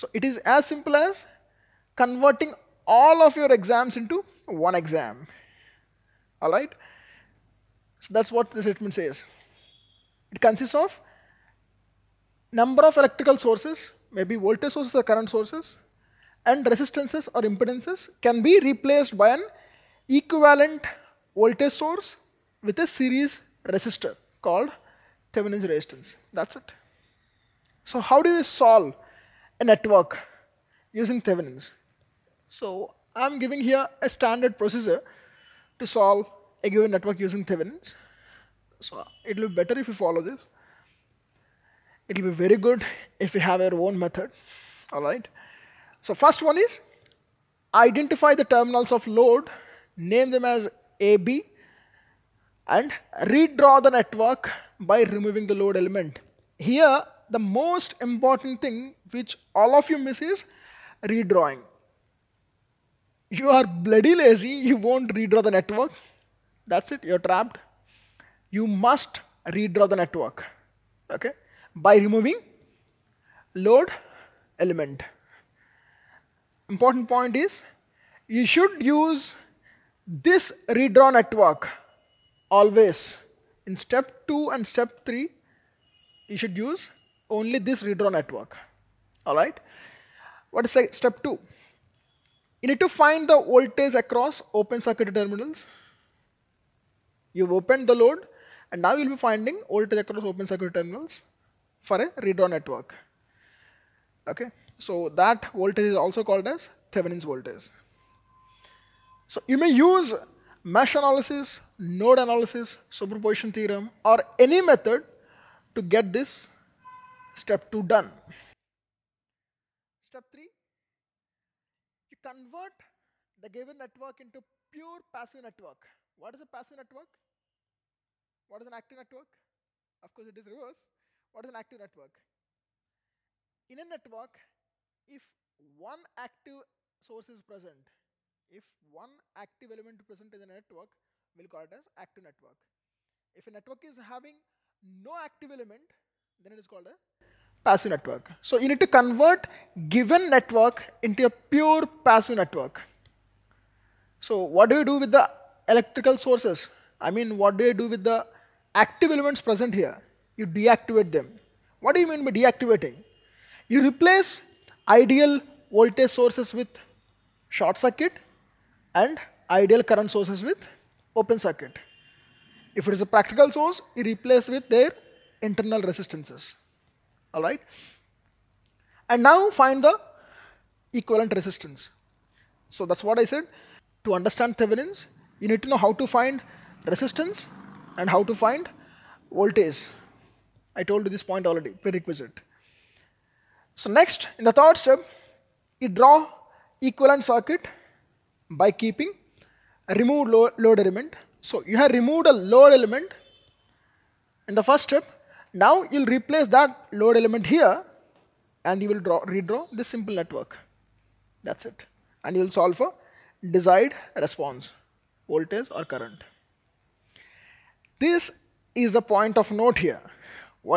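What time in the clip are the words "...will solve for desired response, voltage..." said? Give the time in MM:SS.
03:32.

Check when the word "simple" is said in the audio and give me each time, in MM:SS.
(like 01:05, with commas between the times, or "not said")
00:00, 03:29.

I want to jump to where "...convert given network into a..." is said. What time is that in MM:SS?
02:28.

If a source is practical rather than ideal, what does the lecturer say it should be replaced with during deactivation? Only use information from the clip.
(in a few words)
Internal resistances.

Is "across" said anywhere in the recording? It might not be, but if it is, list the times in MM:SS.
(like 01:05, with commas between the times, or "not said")
01:33, 01:39.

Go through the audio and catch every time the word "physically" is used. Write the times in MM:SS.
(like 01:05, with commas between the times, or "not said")
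not said.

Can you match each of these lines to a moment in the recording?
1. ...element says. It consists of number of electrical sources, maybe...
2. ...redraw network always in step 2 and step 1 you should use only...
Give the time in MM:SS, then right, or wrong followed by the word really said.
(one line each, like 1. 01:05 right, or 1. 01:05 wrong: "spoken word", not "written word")
1. 00:08 wrong: "statement", not "element"
2. 01:20 wrong: "3", not "1".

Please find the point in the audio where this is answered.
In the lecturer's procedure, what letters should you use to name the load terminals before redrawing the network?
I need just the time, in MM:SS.
00:50.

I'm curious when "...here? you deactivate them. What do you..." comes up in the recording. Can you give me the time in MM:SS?
02:39.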